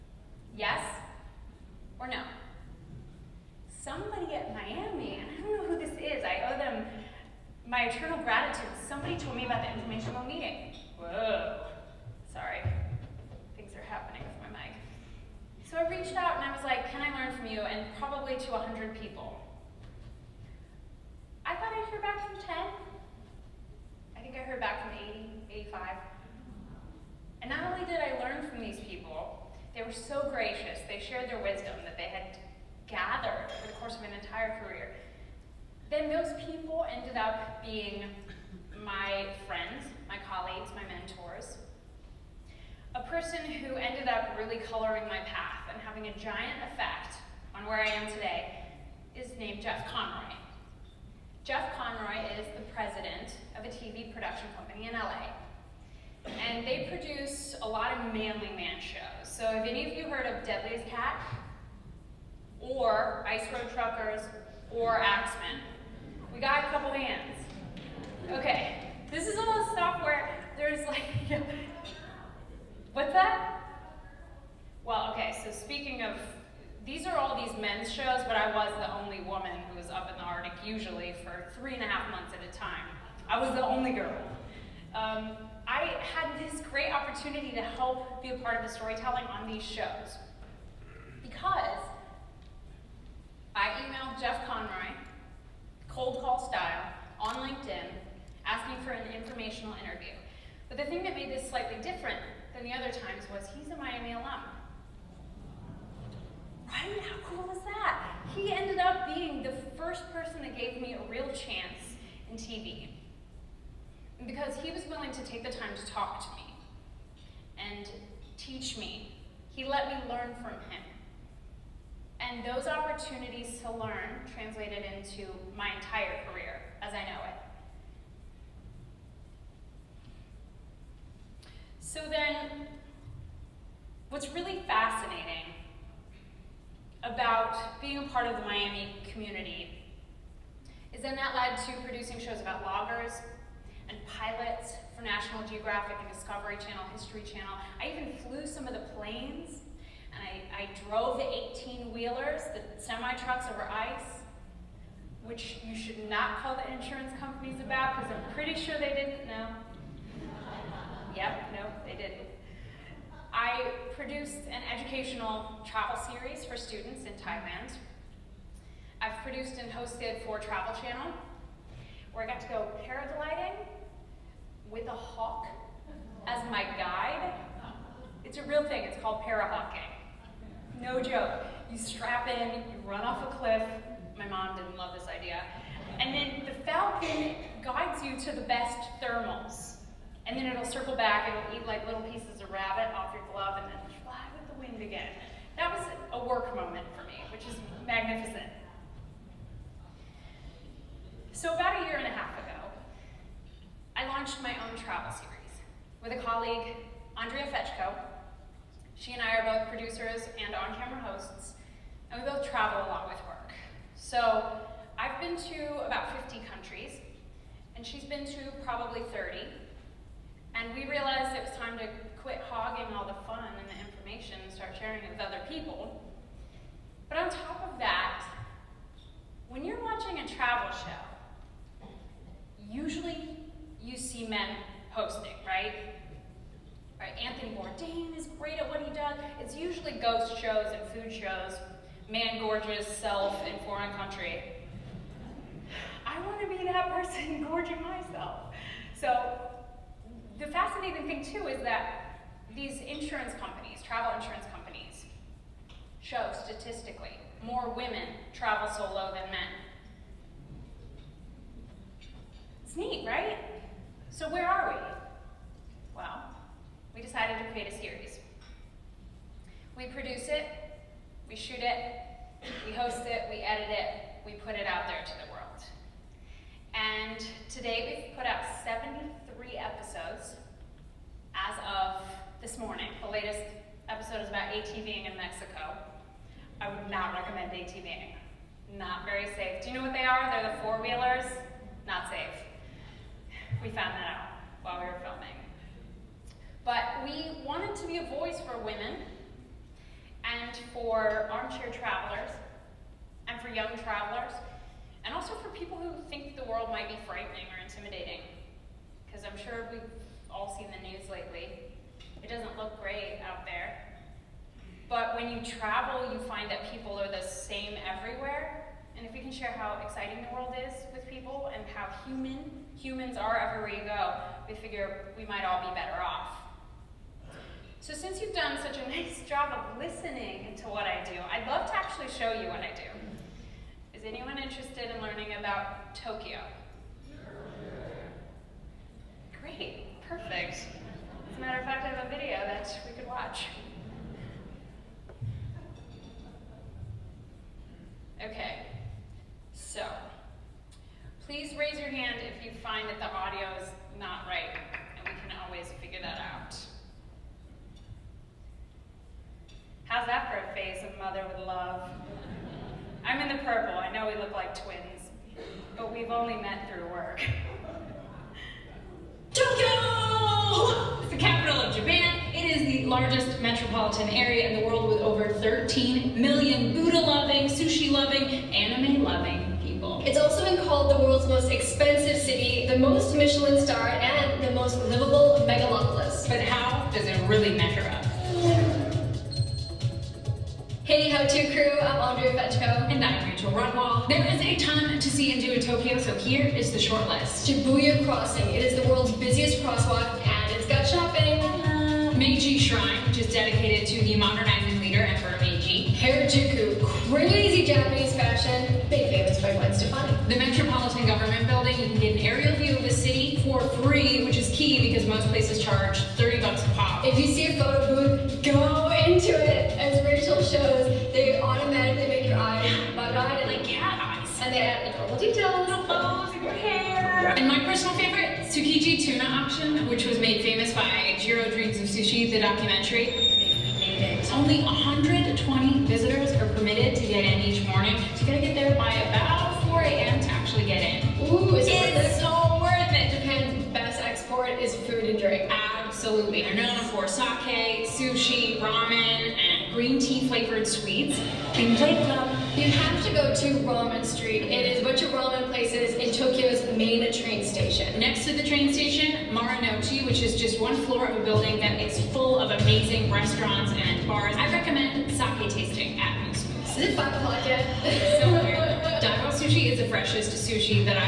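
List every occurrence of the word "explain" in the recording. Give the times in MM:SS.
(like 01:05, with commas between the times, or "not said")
not said.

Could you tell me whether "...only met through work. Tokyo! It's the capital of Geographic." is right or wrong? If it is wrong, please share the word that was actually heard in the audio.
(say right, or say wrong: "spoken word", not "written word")
wrong: "Japan", not "Geographic".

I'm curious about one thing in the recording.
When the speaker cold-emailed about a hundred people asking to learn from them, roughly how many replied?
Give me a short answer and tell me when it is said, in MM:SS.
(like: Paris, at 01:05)
80, at 00:24.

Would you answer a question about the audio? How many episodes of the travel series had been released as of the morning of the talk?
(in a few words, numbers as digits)
73.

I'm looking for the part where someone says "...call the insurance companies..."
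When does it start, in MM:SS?
02:36.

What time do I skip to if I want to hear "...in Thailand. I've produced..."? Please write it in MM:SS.
02:47.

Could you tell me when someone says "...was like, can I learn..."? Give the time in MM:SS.
00:16.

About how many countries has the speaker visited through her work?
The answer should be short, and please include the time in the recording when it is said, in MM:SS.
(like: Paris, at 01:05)
50, at 03:36.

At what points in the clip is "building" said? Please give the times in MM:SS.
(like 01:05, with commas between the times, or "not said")
06:51, 07:41.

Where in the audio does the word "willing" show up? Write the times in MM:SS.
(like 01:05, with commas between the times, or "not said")
01:54.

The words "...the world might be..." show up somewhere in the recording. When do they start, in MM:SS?
05:06.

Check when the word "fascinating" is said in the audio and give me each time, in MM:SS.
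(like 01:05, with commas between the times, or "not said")
02:14, 04:10.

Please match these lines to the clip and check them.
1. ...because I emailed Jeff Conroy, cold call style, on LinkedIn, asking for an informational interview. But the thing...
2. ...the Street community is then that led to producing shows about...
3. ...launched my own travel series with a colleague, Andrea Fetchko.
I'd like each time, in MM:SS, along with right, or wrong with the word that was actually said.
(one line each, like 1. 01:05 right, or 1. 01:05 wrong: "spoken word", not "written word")
1. 01:31 right
2. 02:18 wrong: "Miami", not "Street"
3. 03:24 right.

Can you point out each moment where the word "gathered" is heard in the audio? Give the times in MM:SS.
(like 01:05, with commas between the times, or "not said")
00:32.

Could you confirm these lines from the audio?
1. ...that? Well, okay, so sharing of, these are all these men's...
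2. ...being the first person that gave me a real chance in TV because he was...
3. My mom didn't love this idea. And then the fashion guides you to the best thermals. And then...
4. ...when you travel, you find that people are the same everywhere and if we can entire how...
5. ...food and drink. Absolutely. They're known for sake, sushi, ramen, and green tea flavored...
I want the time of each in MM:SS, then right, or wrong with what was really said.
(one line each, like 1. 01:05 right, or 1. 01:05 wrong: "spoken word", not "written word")
1. 01:13 wrong: "speaking", not "sharing"
2. 01:49 right
3. 03:04 wrong: "falcon", not "fashion"
4. 05:15 wrong: "share", not "entire"
5. 07:24 right.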